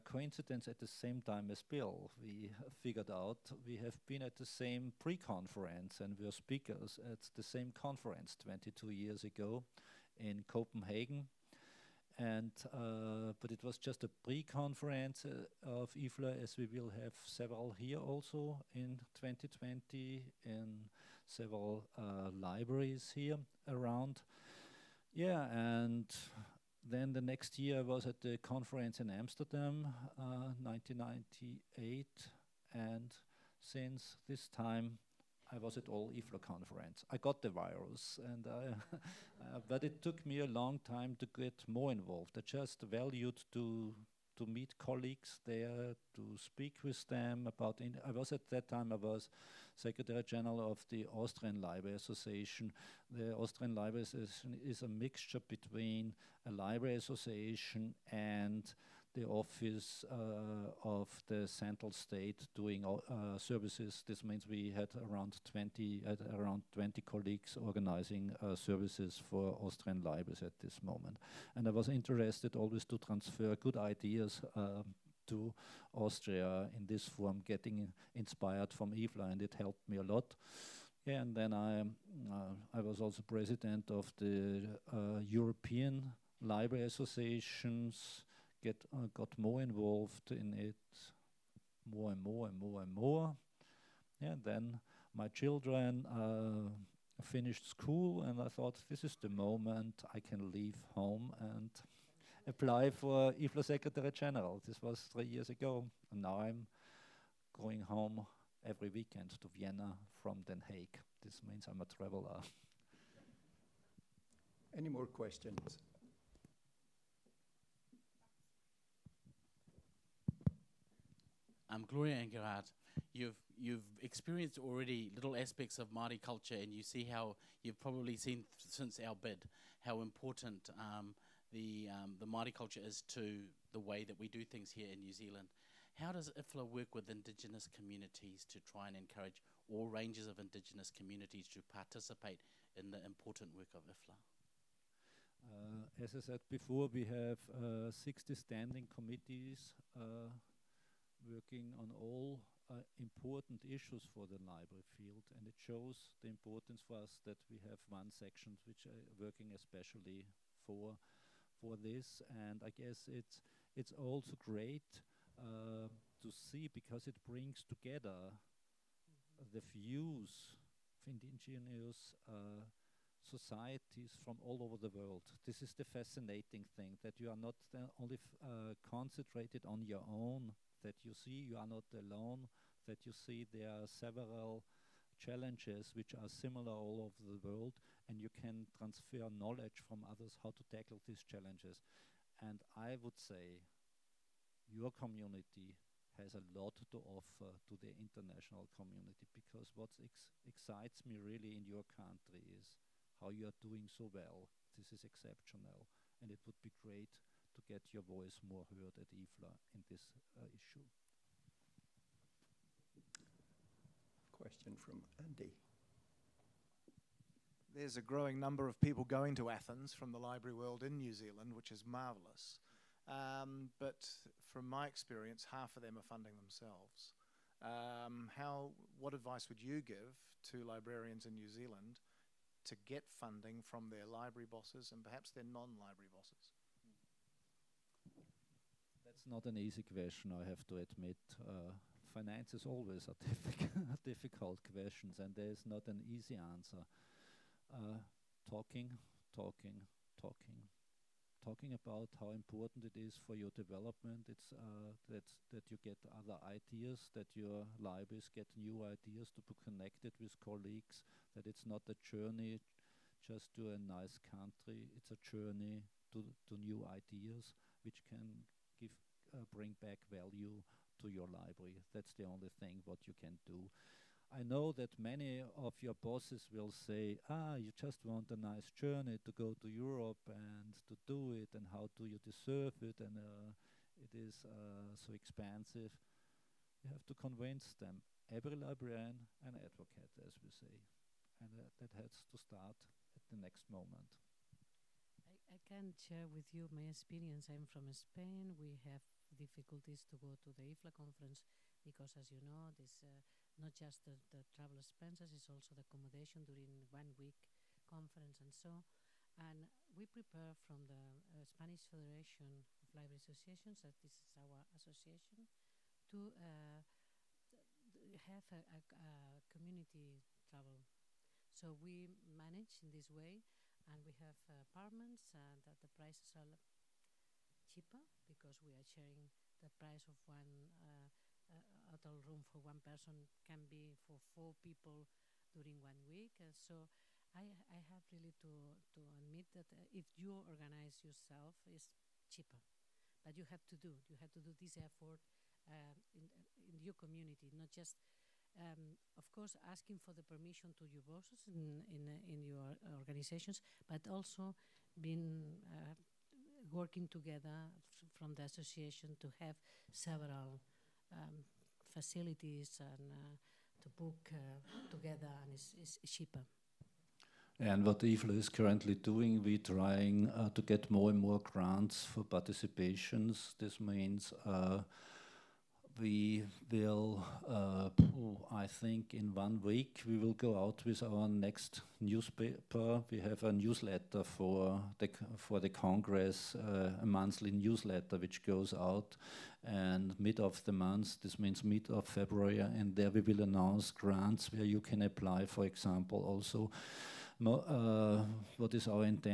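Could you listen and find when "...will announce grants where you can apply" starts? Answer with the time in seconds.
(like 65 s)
393 s.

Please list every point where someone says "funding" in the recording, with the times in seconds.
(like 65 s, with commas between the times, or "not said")
226 s, 233 s.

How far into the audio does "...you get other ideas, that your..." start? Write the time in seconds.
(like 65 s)
255 s.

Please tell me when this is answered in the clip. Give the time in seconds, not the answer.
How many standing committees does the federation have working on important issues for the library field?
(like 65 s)
147 s.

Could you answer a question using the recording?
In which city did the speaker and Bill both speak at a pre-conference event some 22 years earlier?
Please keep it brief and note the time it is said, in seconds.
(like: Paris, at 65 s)
Copenhagen, at 10 s.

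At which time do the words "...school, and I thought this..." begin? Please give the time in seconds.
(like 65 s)
97 s.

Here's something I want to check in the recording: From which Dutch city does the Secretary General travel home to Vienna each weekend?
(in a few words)
Den Haag.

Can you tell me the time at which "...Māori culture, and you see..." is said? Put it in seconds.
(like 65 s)
125 s.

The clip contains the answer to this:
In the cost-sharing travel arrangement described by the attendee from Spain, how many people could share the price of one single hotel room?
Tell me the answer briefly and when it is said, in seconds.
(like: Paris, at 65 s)
4, at 334 s.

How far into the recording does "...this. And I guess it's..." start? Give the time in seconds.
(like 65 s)
161 s.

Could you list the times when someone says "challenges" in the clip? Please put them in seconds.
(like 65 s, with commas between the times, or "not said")
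185 s, 191 s.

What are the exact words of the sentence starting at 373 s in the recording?
This means uh, we will uh, I think in one week we will go out with our next newspaper.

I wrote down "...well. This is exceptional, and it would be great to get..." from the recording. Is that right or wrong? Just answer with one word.
right.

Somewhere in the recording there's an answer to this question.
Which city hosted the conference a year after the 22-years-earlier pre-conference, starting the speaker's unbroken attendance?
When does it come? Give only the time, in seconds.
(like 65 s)
29 s.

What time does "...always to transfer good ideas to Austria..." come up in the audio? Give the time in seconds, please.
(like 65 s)
72 s.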